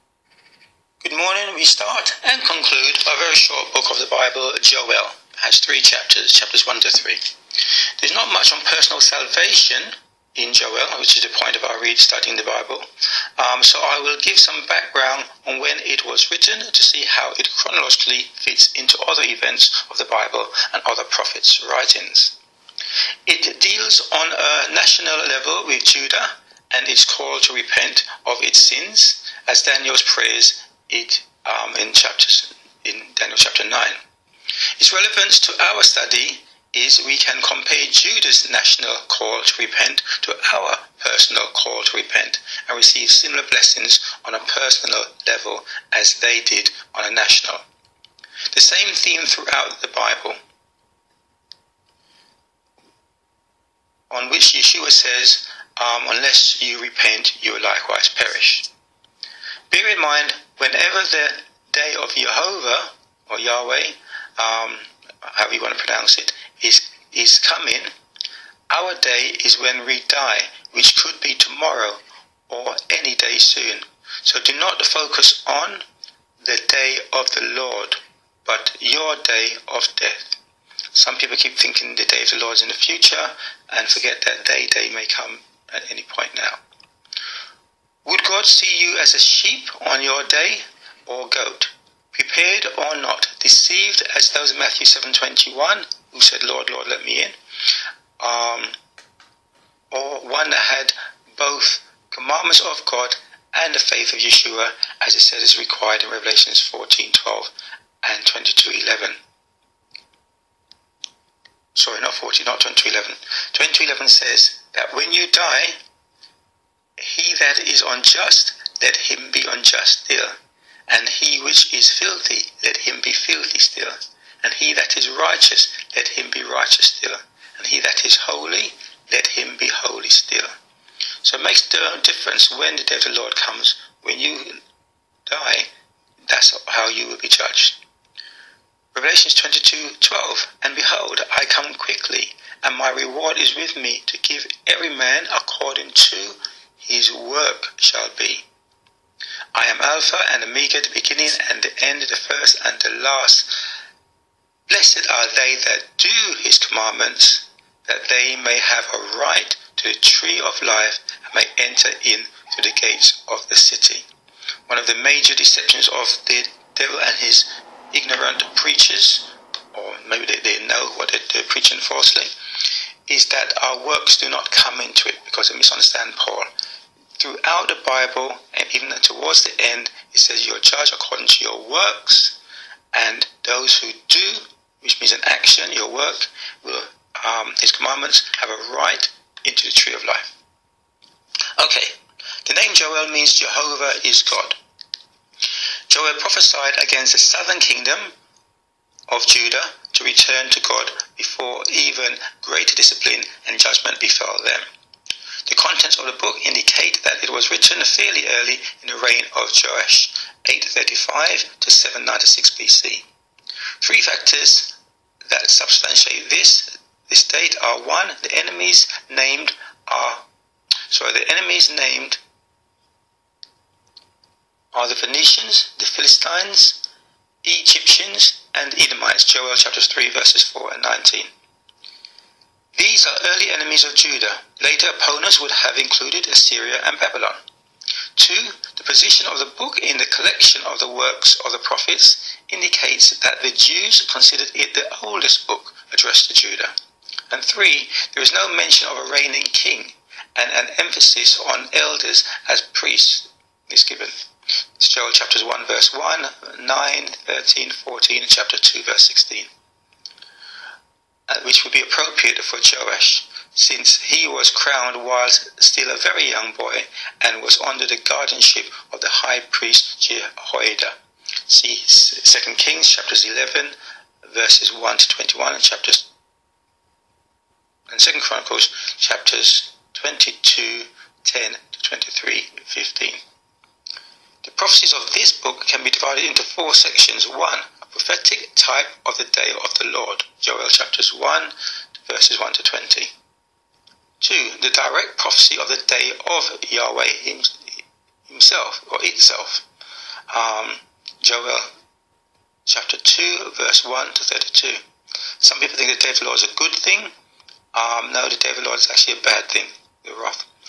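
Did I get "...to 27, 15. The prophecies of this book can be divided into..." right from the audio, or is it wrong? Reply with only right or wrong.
wrong.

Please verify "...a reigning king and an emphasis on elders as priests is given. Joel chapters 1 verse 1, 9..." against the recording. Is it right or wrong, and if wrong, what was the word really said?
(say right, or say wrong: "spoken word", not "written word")
right.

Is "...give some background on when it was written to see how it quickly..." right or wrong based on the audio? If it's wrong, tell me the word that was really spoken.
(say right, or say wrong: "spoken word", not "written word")
wrong: "chronologically", not "quickly".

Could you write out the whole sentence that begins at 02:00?
And he which is filthy, let him be filthy still.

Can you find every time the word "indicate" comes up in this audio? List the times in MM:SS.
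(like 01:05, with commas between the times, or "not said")
03:26, 04:02.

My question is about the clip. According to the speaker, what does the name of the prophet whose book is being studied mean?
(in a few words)
Jehovah is God.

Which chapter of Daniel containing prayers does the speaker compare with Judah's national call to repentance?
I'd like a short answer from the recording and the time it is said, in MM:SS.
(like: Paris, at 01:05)
Chapter 9, at 00:33.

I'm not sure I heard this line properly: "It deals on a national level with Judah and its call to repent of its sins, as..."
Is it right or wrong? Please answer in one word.
right.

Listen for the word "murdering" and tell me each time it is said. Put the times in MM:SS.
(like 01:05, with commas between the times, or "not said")
not said.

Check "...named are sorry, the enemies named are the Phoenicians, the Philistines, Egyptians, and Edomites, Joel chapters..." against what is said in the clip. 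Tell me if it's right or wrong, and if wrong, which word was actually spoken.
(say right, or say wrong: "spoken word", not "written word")
right.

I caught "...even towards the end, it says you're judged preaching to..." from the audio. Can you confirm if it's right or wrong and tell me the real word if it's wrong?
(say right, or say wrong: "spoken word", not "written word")
wrong: "according", not "preaching".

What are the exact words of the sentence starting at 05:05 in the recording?
Some people think the day of the Lord is a good thing.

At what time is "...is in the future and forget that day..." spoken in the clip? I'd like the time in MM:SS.
01:22.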